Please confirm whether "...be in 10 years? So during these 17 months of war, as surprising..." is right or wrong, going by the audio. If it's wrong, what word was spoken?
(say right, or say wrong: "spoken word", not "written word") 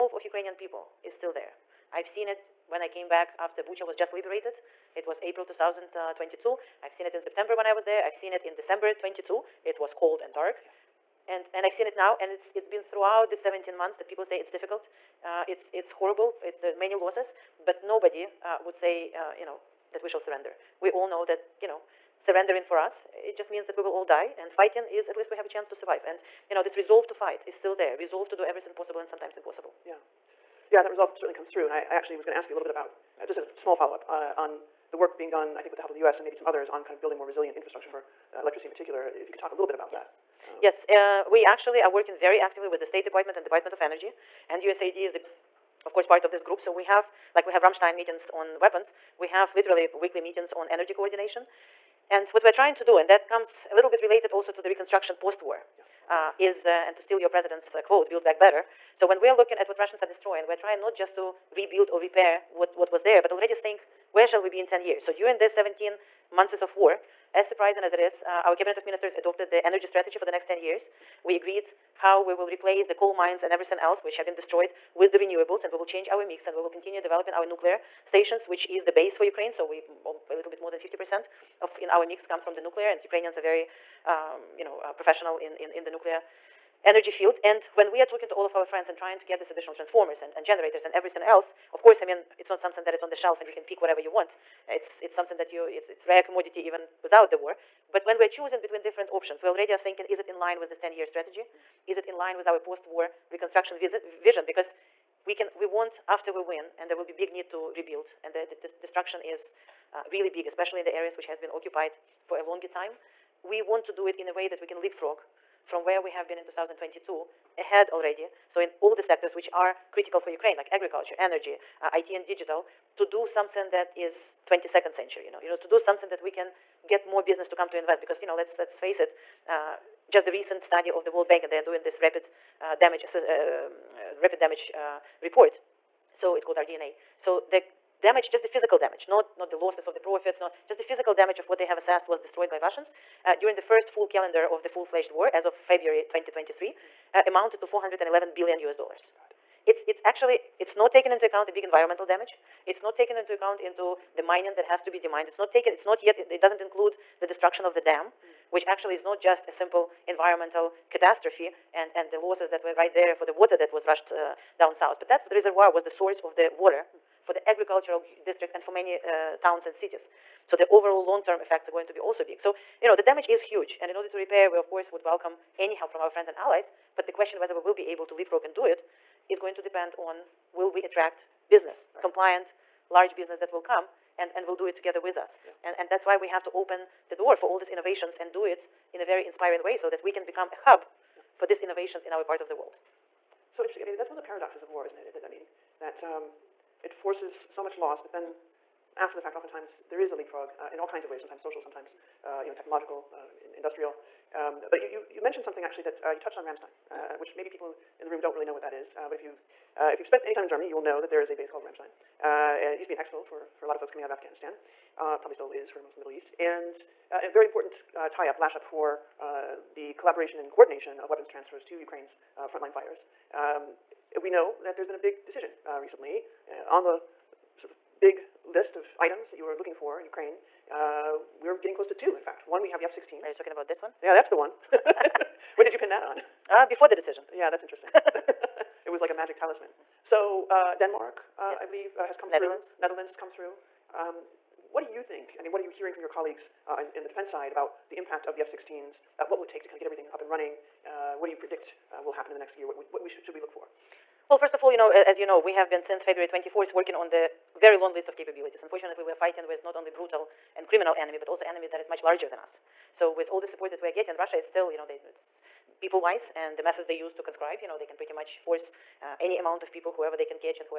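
right.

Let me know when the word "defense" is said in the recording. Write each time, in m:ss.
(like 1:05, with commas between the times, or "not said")
4:07.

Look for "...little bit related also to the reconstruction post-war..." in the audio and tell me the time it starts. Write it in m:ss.
0:53.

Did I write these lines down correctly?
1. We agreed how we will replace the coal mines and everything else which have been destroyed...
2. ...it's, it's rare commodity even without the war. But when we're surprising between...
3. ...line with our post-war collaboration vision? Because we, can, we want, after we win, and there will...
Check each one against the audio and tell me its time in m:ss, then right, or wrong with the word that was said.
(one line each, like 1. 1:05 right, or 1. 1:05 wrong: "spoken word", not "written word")
1. 1:11 right
2. 1:35 wrong: "choosing", not "surprising"
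3. 1:42 wrong: "reconstruction", not "collaboration".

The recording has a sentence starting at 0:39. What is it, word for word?
If you could talk a little bit about yes.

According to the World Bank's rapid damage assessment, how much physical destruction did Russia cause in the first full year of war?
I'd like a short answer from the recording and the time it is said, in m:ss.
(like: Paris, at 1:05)
$411 billion, at 2:27.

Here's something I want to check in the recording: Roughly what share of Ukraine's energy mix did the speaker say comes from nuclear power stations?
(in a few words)
a little more than 50%.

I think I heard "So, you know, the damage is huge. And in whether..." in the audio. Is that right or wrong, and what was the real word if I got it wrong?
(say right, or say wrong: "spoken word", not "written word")
wrong: "order", not "whether".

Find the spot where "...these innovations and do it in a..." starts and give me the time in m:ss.
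3:07.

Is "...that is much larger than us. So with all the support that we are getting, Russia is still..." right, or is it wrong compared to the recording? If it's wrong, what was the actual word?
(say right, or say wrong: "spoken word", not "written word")
right.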